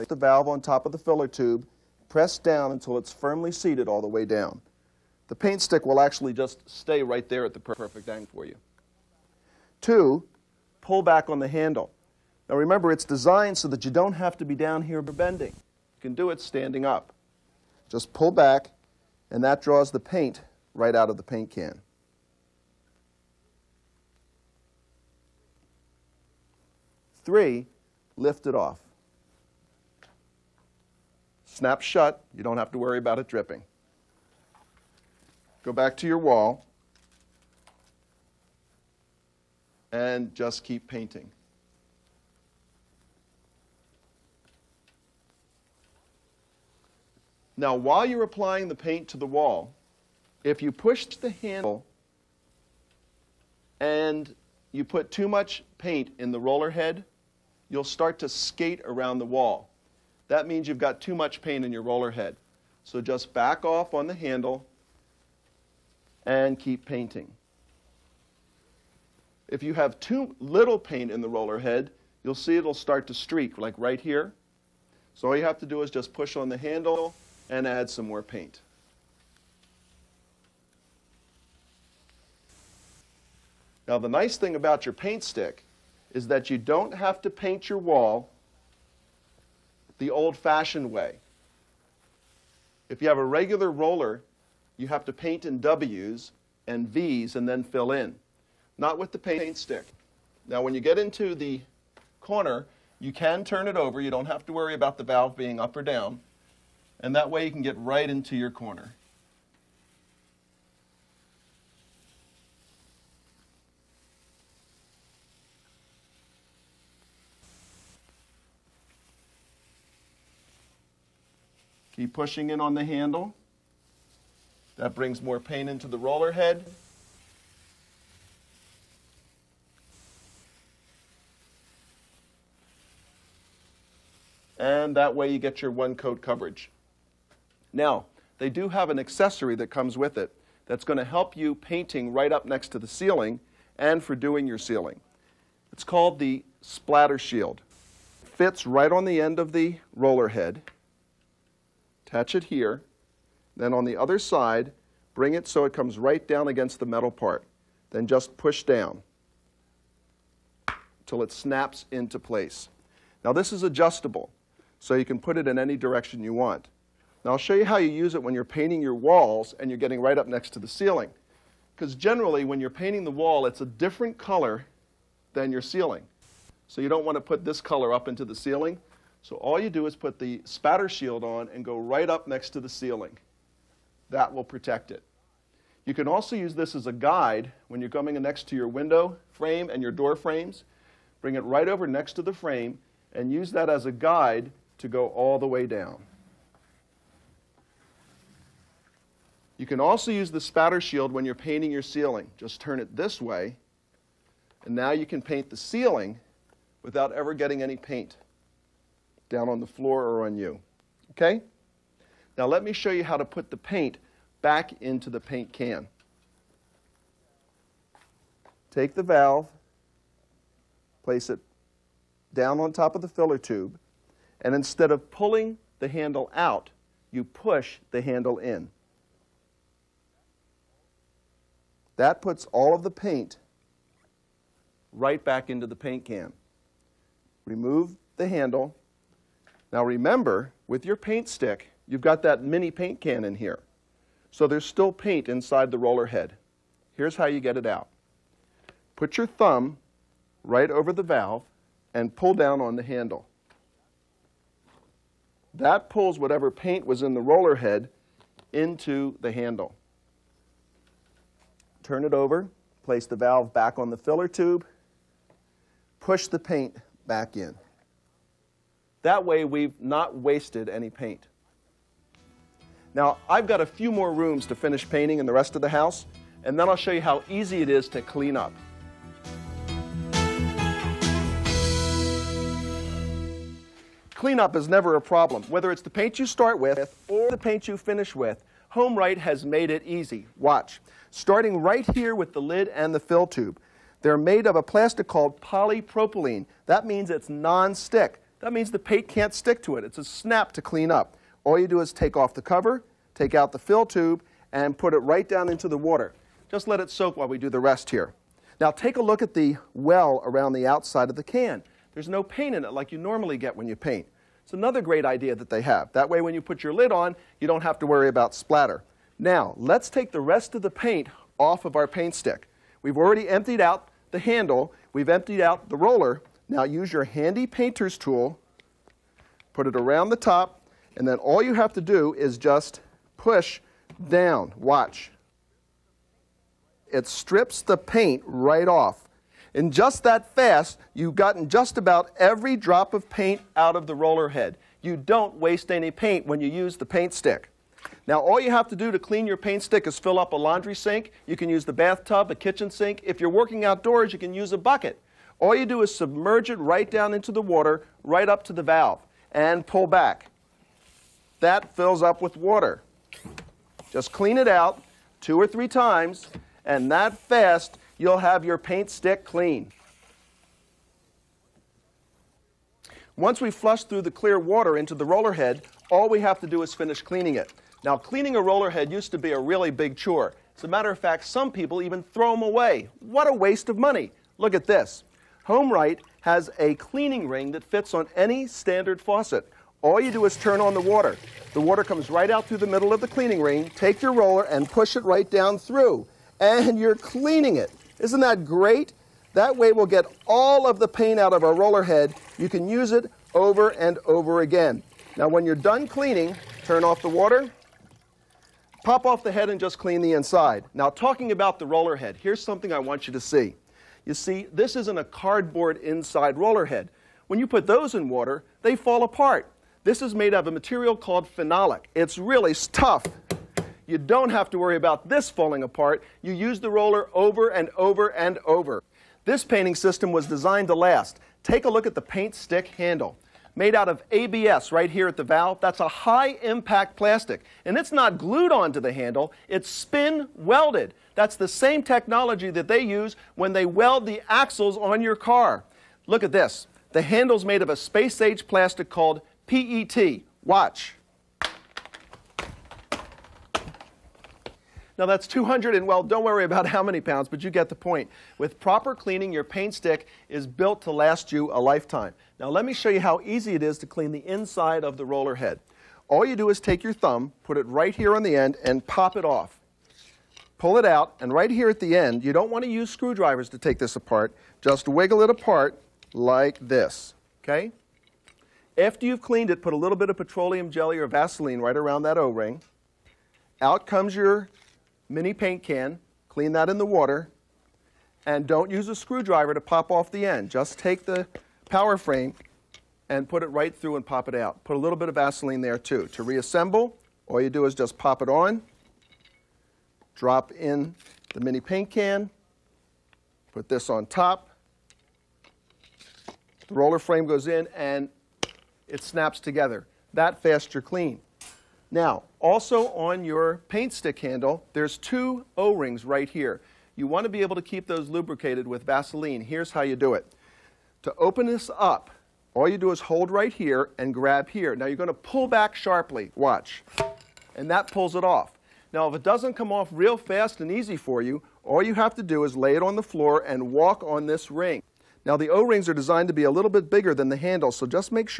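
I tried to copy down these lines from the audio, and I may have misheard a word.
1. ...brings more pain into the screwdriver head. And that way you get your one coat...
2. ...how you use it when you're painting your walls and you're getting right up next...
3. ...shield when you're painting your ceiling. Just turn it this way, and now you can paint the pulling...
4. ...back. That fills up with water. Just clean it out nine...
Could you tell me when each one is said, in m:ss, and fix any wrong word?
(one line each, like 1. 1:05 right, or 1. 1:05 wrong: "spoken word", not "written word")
1. 2:04 wrong: "roller", not "screwdriver"
2. 2:47 right
3. 3:20 wrong: "ceiling", not "pulling"
4. 5:59 wrong: "two", not "nine".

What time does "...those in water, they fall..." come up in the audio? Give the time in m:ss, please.
6:57.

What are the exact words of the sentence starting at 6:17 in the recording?
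Now, cleaning a roller head used to be a really big chore.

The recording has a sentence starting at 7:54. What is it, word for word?
Just wiggle it apart like this, okay?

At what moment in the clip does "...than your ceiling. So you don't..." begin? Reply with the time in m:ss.
2:55.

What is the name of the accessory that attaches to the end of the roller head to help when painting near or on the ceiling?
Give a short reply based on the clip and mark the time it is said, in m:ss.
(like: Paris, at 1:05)
splatter shield, at 2:26.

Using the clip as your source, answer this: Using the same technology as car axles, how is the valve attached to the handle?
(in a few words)
spin welded.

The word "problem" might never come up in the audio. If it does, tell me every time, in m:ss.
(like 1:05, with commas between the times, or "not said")
4:44.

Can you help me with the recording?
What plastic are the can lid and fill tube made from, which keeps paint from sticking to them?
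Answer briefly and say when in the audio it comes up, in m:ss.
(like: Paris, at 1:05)
polypropylene, at 4:55.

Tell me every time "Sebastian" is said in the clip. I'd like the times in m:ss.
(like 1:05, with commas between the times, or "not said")
not said.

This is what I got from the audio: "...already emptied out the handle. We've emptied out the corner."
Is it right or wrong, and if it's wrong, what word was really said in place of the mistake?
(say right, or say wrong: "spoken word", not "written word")
wrong: "roller", not "corner".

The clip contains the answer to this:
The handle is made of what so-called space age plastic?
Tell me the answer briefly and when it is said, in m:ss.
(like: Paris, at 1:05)
PET, at 7:29.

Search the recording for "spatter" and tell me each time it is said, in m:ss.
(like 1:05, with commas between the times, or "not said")
3:00, 3:20.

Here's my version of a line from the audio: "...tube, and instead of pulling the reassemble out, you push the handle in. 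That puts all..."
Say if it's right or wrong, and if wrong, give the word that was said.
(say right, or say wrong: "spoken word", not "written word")
wrong: "handle", not "reassemble".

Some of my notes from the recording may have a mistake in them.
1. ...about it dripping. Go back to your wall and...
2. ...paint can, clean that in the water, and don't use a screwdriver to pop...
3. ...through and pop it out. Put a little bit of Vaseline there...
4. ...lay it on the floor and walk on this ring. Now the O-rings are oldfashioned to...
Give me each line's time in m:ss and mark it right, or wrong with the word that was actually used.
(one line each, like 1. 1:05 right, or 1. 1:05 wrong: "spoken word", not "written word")
1. 0:32 right
2. 8:05 right
3. 8:13 right
4. 8:52 wrong: "designed", not "oldfashioned".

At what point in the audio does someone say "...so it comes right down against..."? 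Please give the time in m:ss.
2:35.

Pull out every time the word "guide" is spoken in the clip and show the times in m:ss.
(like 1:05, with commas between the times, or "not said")
3:06, 3:13.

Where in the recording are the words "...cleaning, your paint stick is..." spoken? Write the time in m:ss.
7:38.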